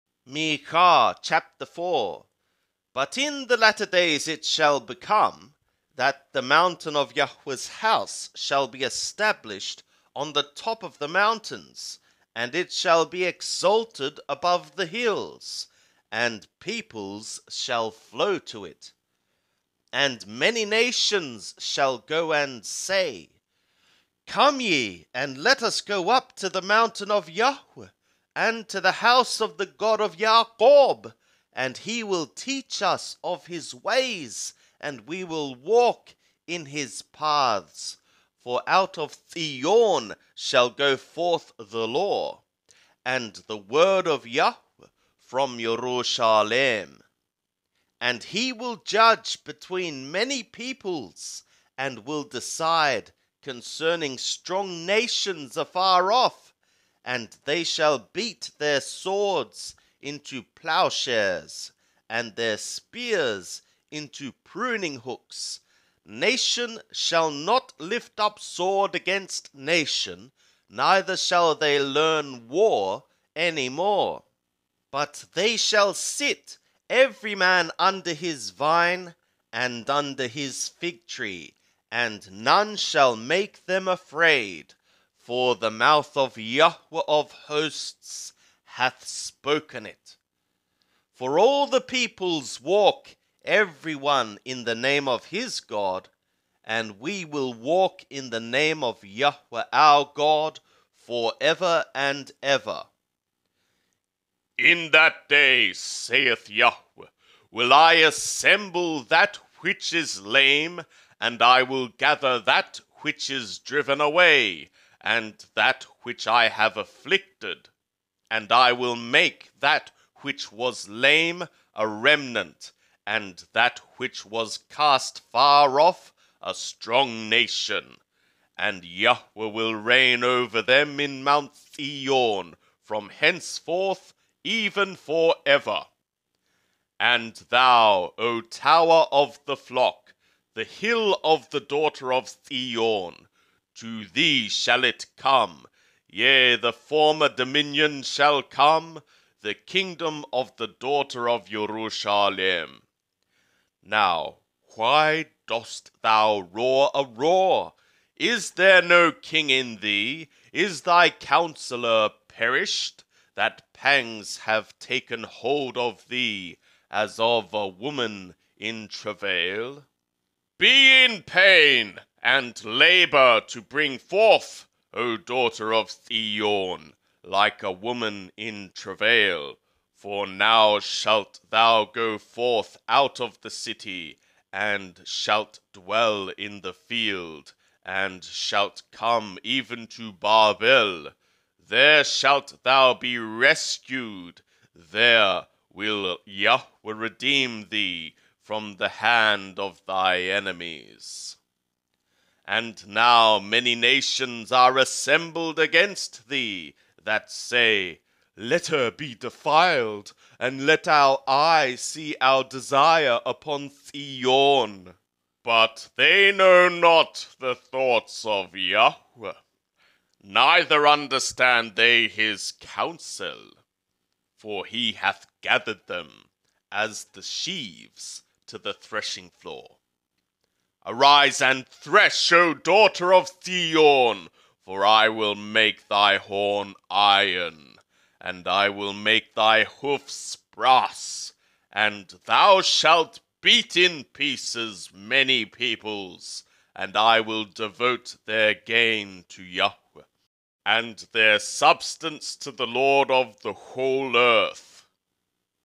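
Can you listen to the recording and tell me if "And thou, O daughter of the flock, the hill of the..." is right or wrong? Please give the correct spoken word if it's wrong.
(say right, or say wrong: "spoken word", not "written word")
wrong: "tower", not "daughter".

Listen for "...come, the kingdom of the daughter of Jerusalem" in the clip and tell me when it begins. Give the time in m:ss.
2:28.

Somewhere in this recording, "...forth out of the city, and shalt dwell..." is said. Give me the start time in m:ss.
3:02.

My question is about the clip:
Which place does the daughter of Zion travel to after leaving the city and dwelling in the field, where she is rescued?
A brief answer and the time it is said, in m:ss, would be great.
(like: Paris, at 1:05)
Babel, at 3:10.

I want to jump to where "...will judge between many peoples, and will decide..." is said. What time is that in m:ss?
0:48.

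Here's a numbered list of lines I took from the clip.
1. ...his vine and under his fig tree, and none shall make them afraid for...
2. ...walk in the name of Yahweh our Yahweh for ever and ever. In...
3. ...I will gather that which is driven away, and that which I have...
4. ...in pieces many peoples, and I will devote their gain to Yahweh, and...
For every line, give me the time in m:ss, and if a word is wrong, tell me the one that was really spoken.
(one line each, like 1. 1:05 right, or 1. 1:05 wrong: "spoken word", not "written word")
1. 1:18 right
2. 1:37 wrong: "God", not "Yahweh"
3. 1:51 right
4. 4:03 right.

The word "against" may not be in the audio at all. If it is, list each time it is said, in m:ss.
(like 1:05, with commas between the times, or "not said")
1:08, 3:25.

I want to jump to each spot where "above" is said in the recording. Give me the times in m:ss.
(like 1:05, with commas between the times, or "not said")
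0:14.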